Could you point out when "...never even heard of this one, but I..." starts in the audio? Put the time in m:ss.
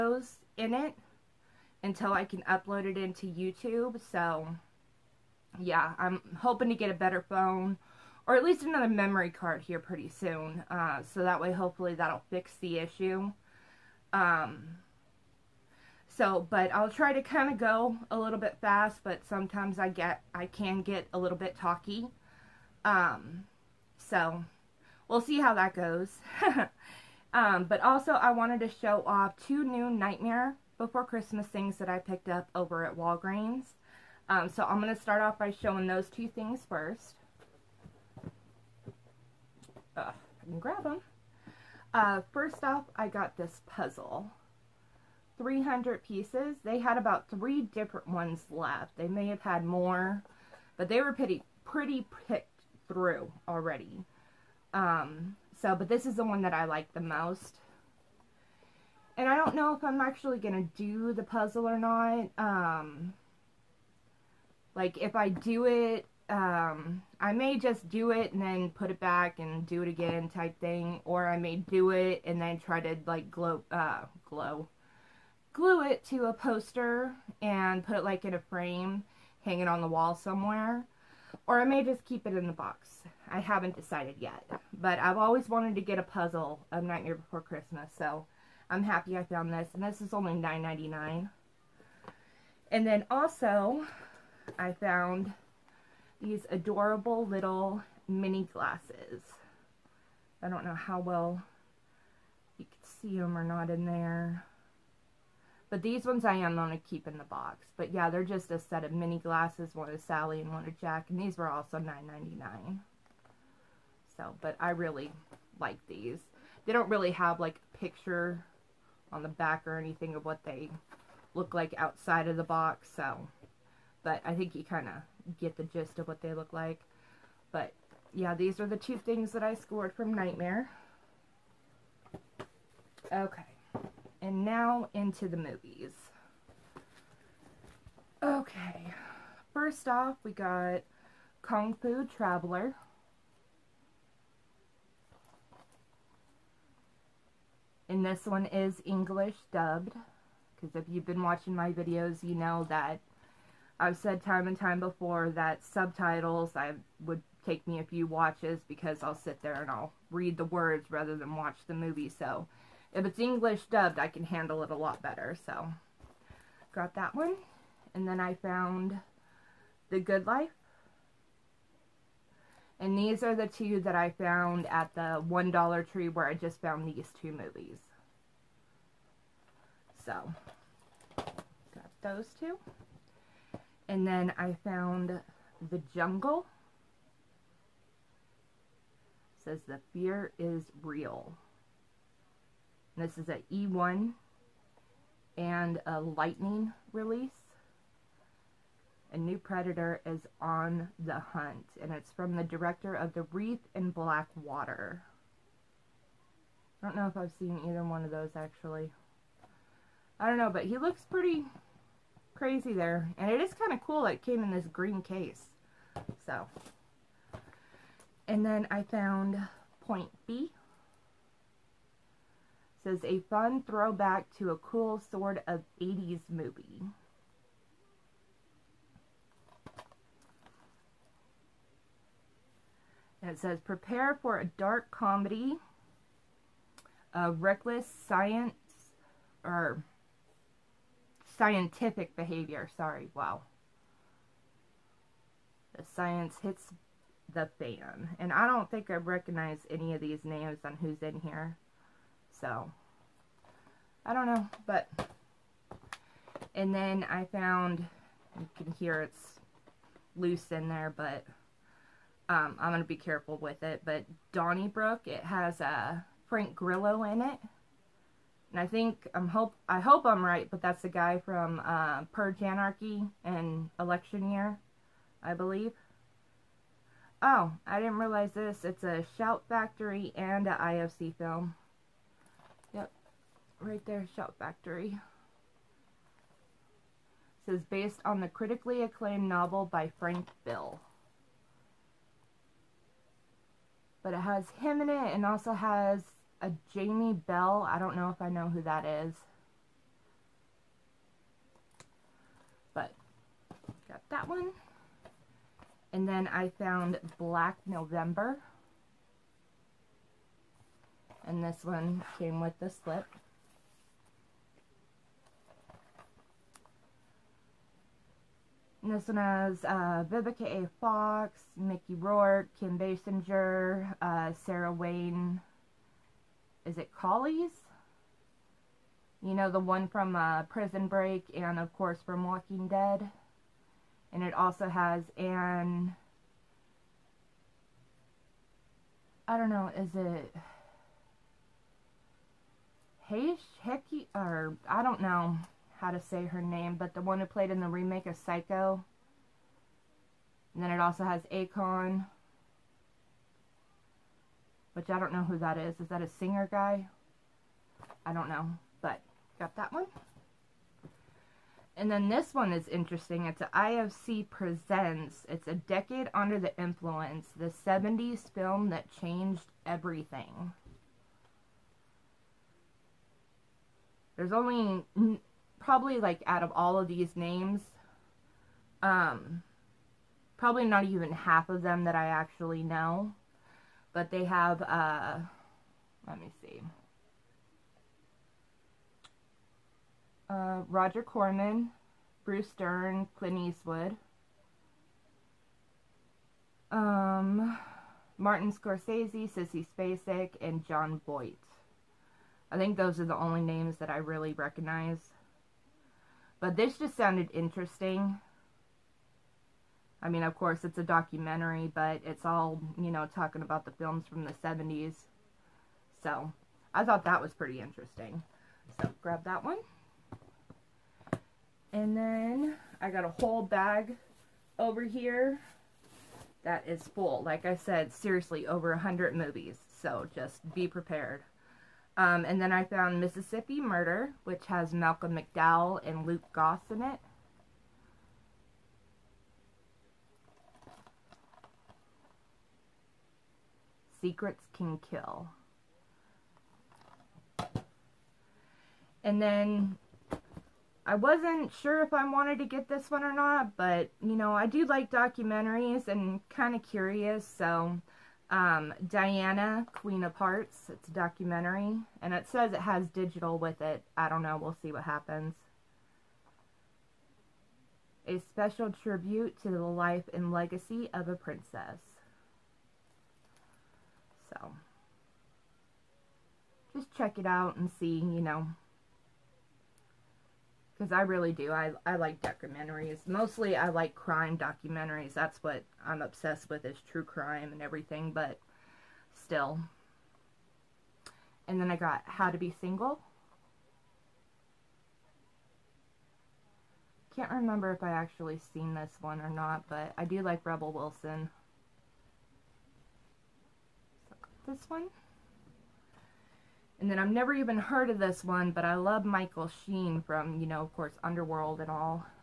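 8:27.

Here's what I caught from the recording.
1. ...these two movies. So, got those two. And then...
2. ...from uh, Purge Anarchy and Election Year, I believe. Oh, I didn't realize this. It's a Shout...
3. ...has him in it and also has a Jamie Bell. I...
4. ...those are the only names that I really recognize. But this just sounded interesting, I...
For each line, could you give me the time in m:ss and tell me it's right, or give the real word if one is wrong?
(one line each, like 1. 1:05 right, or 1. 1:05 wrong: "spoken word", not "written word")
1. 2:56 right
2. 4:31 right
3. 4:54 right
4. 6:42 right.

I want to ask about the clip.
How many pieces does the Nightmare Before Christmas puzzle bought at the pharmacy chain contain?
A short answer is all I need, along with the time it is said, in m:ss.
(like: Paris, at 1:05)
300, at 0:45.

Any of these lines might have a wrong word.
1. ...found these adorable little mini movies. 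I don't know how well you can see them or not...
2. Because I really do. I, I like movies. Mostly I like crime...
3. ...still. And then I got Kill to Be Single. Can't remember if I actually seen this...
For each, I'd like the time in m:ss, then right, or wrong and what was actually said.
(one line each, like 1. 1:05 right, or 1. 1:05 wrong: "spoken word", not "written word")
1. 1:34 wrong: "glasses", not "movies"
2. 8:00 wrong: "documentaries", not "movies"
3. 8:09 wrong: "How", not "Kill".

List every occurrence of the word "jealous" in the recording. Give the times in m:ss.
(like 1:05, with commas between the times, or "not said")
not said.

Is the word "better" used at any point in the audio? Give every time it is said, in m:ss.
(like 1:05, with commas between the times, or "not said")
0:06, 2:45.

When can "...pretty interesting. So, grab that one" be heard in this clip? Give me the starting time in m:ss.
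6:57.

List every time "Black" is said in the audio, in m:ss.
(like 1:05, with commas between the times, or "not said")
3:23, 5:07.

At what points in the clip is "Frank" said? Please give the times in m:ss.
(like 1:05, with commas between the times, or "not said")
4:26, 4:49.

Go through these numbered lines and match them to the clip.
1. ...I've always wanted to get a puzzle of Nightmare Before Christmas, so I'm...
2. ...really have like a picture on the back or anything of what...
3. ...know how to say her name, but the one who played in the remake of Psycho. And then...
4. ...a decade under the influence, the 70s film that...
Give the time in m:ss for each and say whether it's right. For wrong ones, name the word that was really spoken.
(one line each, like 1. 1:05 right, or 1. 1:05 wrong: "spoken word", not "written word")
1. 1:25 right
2. 1:56 right
3. 5:45 right
4. 6:05 right.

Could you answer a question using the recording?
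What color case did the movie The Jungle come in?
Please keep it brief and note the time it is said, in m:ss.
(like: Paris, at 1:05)
Green, at 3:34.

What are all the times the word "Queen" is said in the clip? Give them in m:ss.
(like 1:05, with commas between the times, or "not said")
7:39.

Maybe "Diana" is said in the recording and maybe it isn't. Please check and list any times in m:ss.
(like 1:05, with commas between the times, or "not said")
7:38.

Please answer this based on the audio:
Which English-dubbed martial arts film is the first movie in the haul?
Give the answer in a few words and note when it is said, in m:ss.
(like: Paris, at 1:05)
Kung Fu Traveler, at 2:21.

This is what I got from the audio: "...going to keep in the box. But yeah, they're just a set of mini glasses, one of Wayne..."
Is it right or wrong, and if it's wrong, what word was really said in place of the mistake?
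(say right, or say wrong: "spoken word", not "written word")
wrong: "Sally", not "Wayne".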